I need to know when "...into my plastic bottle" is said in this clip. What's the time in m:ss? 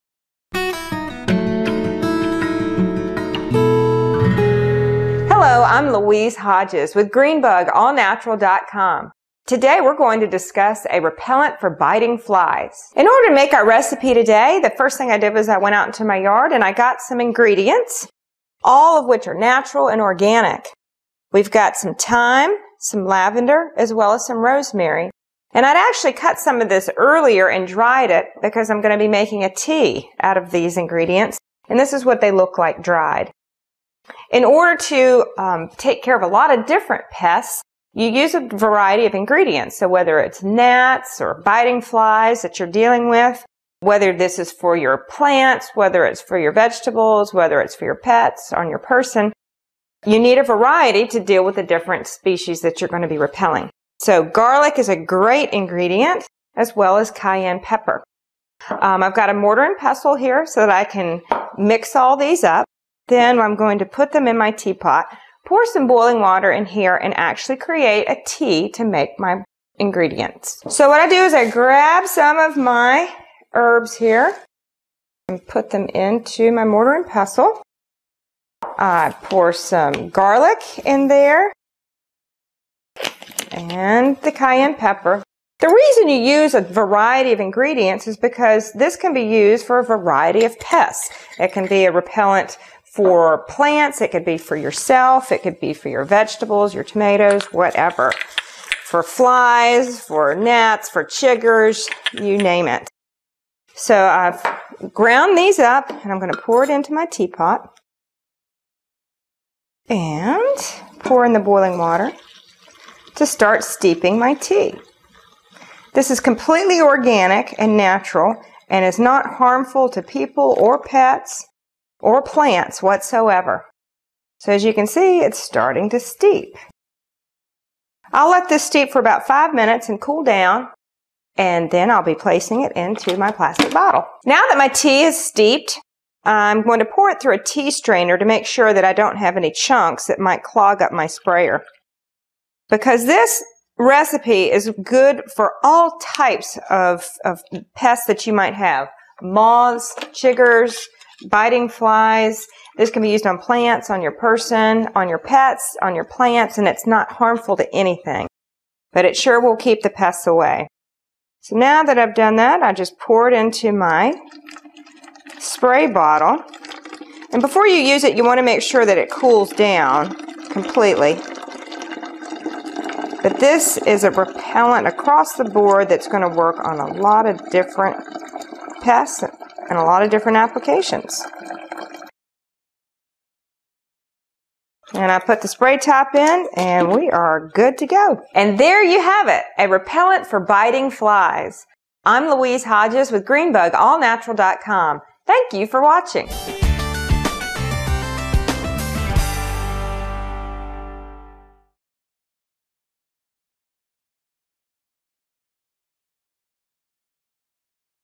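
2:12.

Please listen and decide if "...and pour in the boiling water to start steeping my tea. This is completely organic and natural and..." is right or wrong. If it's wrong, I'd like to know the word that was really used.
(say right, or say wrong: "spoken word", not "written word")
right.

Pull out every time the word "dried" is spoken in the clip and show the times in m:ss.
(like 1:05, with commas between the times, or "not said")
0:27, 0:32.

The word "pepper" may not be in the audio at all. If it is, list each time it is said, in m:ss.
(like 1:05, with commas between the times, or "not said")
0:57, 1:24.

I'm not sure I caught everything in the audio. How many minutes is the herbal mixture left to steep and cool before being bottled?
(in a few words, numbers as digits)
5.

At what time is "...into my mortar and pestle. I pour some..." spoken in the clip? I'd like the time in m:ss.
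1:15.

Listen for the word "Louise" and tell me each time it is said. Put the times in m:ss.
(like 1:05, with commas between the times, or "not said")
0:05, 3:12.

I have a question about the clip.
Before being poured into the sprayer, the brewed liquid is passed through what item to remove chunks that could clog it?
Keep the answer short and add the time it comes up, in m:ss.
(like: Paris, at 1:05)
tea strainer, at 2:17.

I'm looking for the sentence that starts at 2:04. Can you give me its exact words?
So as you can see, it's starting to steep.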